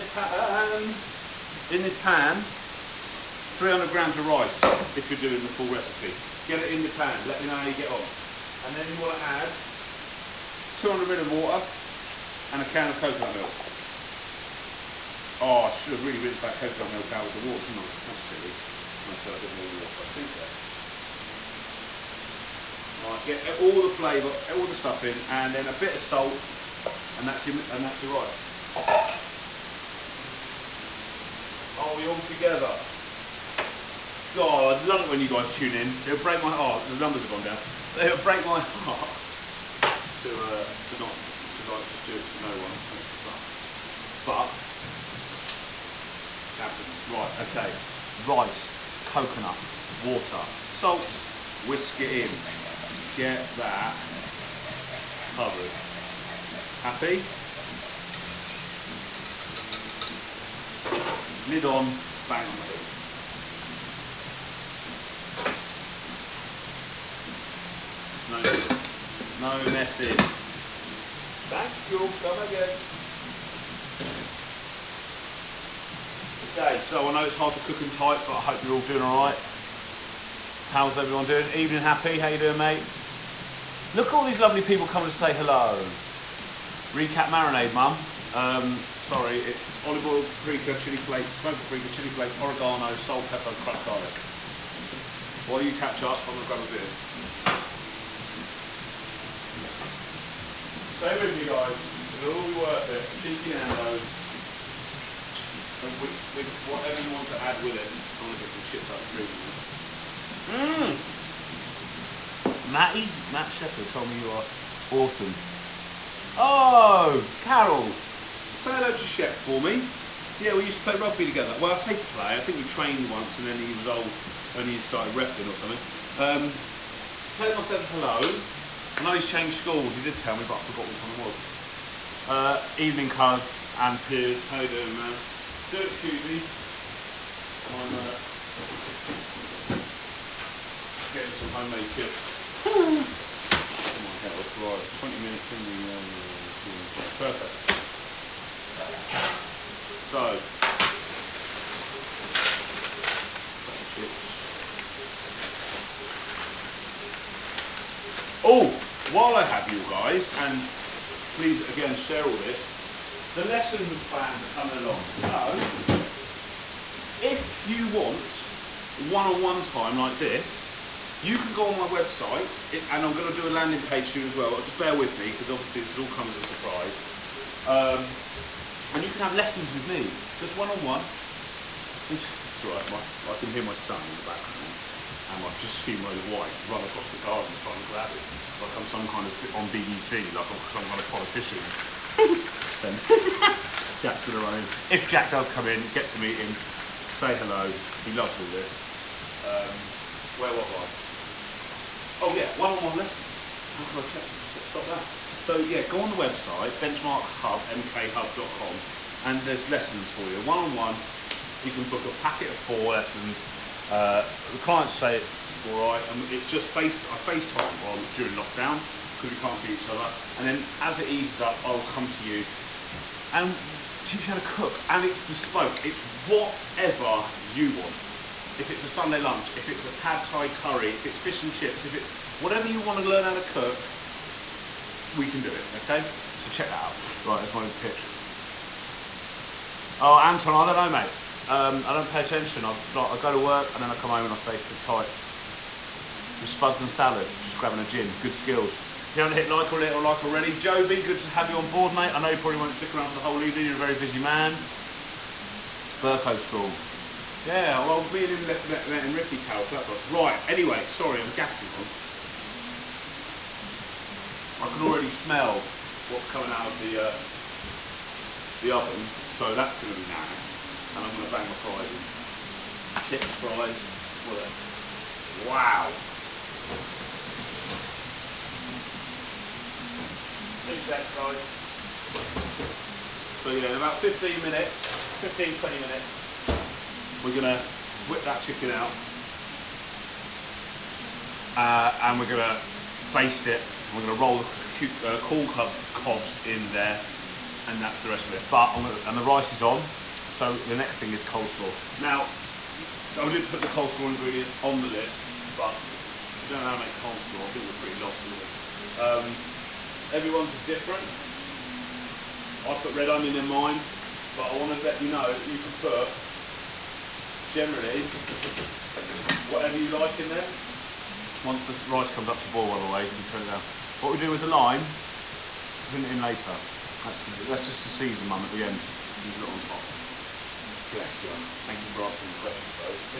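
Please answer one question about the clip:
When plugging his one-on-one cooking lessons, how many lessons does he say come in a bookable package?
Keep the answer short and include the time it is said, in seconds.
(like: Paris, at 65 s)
4, at 212 s.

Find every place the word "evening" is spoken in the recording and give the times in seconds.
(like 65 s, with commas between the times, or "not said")
81 s, 132 s, 253 s.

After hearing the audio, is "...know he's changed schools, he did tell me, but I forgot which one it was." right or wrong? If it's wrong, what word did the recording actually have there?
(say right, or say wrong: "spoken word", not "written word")
right.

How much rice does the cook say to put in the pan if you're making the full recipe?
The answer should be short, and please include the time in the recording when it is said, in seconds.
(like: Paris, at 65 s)
300 grams, at 3 s.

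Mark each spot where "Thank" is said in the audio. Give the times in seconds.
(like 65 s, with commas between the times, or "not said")
71 s, 331 s.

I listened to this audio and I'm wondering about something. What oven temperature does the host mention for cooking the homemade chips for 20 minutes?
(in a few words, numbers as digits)
220.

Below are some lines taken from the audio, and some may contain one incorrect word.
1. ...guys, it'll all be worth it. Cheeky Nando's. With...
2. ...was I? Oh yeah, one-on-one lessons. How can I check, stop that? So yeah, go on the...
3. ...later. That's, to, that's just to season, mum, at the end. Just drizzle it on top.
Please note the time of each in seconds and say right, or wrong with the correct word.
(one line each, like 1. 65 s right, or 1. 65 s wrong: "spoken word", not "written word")
1. 101 s right
2. 200 s right
3. 326 s right.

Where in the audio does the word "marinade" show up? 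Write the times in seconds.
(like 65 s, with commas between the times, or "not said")
87 s.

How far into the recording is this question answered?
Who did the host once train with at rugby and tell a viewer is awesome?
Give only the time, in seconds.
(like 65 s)
113 s.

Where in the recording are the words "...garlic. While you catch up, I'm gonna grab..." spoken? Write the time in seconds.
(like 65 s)
93 s.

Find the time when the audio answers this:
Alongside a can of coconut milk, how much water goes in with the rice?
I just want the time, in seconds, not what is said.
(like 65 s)
10 s.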